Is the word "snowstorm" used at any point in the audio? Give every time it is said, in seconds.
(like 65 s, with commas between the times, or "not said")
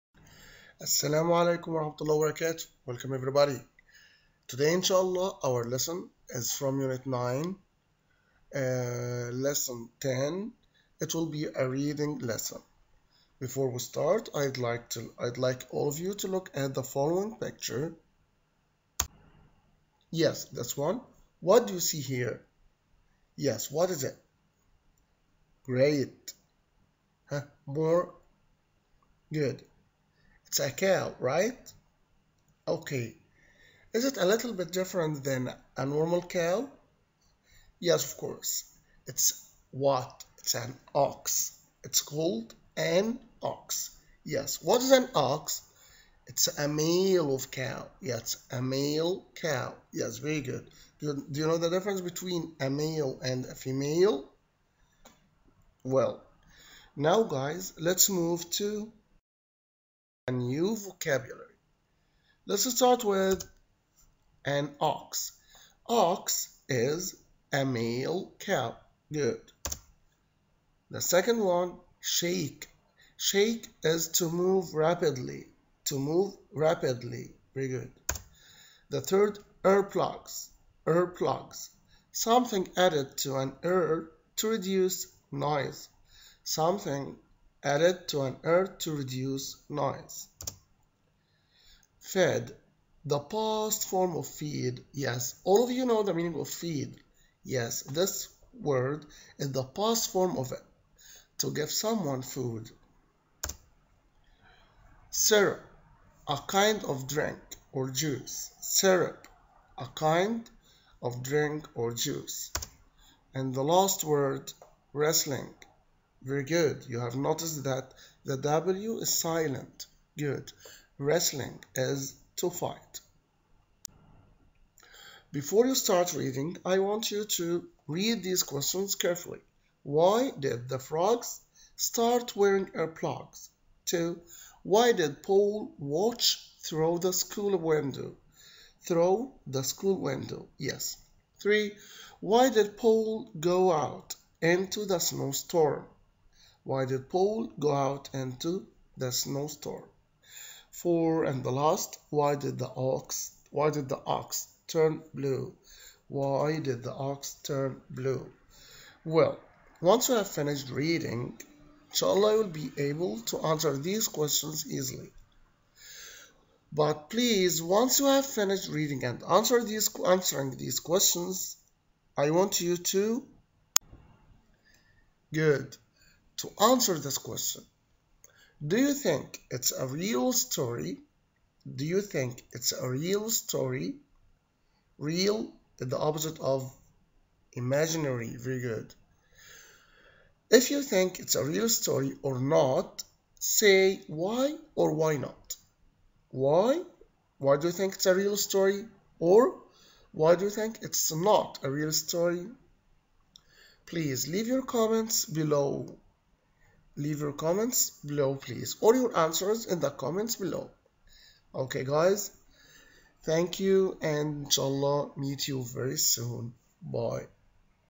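144 s, 149 s.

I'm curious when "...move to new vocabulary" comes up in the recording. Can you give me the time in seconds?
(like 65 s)
58 s.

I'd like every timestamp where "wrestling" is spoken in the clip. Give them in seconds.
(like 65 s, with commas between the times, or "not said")
114 s, 120 s.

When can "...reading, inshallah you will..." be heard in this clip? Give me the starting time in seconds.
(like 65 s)
160 s.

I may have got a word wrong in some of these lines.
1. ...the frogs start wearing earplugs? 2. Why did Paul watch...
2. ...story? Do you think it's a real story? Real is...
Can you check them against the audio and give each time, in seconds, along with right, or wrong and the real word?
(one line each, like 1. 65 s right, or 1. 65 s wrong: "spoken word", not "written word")
1. 130 s right
2. 180 s right.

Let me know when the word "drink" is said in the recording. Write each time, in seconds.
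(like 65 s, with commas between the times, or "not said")
107 s, 111 s.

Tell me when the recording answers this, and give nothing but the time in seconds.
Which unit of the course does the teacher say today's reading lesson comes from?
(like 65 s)
6 s.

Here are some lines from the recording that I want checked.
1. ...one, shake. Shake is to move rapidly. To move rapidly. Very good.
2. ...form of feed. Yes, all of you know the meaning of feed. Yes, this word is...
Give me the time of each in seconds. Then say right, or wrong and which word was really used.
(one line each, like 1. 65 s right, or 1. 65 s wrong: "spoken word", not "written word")
1. 71 s right
2. 93 s right.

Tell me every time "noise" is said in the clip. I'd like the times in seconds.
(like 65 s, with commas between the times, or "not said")
85 s, 89 s.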